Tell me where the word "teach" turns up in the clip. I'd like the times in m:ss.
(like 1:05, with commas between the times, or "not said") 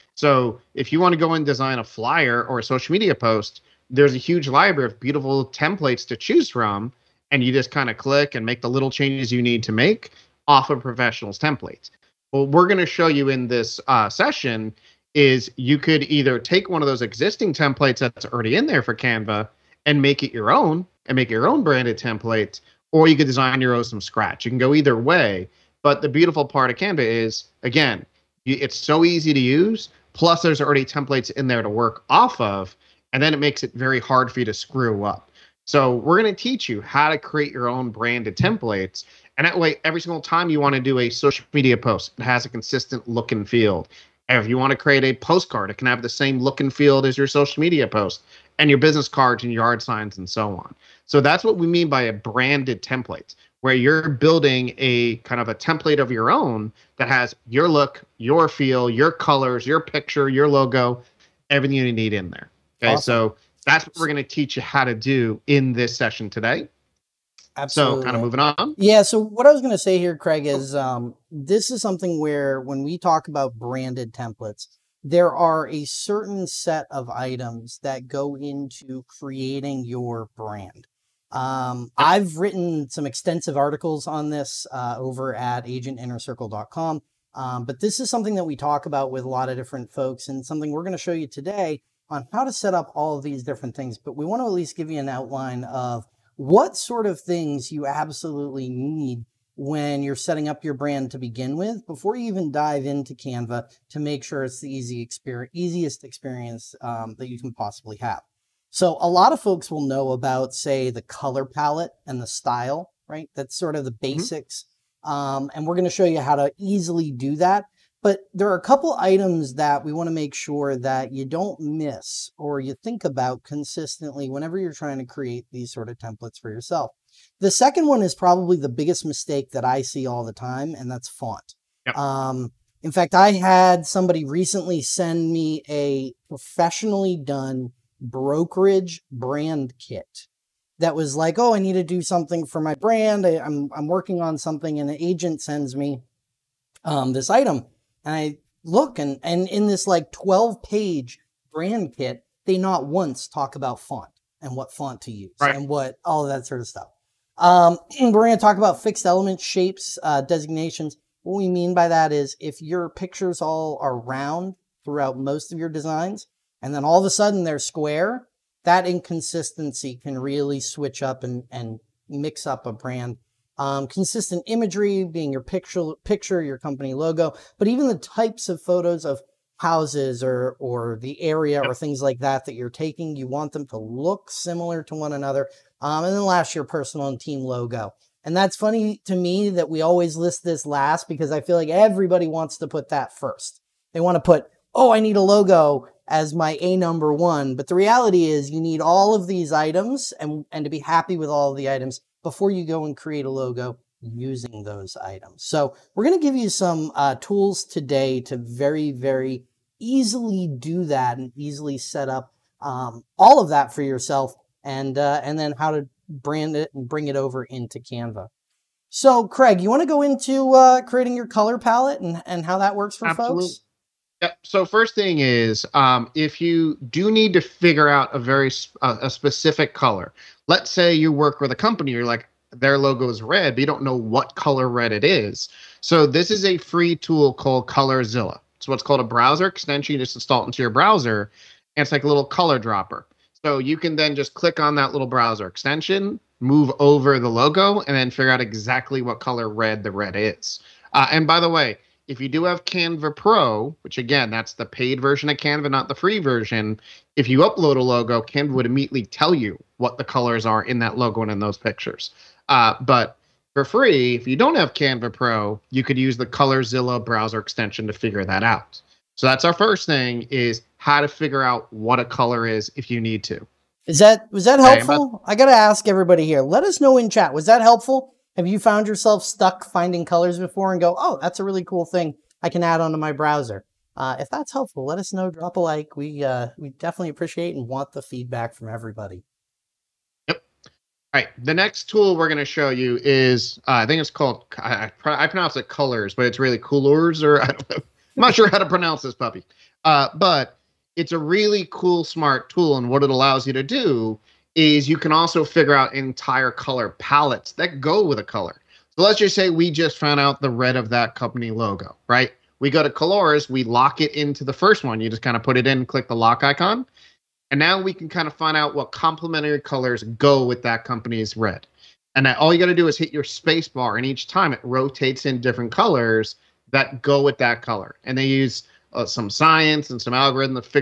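0:36, 1:04.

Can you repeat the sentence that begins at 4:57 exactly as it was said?
I'm not sure how to pronounce this puppy.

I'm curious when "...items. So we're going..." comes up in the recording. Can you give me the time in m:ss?
3:24.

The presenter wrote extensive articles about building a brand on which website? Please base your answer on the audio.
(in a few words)
agentinnercircle.com.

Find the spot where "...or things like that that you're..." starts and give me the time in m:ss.
3:01.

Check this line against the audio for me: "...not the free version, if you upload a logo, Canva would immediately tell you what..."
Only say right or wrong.
right.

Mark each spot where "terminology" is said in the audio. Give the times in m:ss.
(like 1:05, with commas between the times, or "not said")
not said.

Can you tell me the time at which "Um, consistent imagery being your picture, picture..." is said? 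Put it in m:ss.
2:53.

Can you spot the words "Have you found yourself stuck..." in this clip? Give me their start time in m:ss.
4:38.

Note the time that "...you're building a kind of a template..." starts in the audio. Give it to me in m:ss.
0:53.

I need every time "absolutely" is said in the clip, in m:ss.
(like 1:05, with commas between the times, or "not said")
1:07, 1:37, 3:43.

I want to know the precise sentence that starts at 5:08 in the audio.
So let's just say we just found out the red of that company logo, right?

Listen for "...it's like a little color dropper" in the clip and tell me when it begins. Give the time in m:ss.
4:01.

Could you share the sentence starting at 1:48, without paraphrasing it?
So a lot of folks will know about, say, the color palette and the style, right?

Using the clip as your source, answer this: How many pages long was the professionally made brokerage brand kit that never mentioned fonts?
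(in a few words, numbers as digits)
12.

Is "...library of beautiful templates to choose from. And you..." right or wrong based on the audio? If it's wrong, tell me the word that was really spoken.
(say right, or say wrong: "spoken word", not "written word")
right.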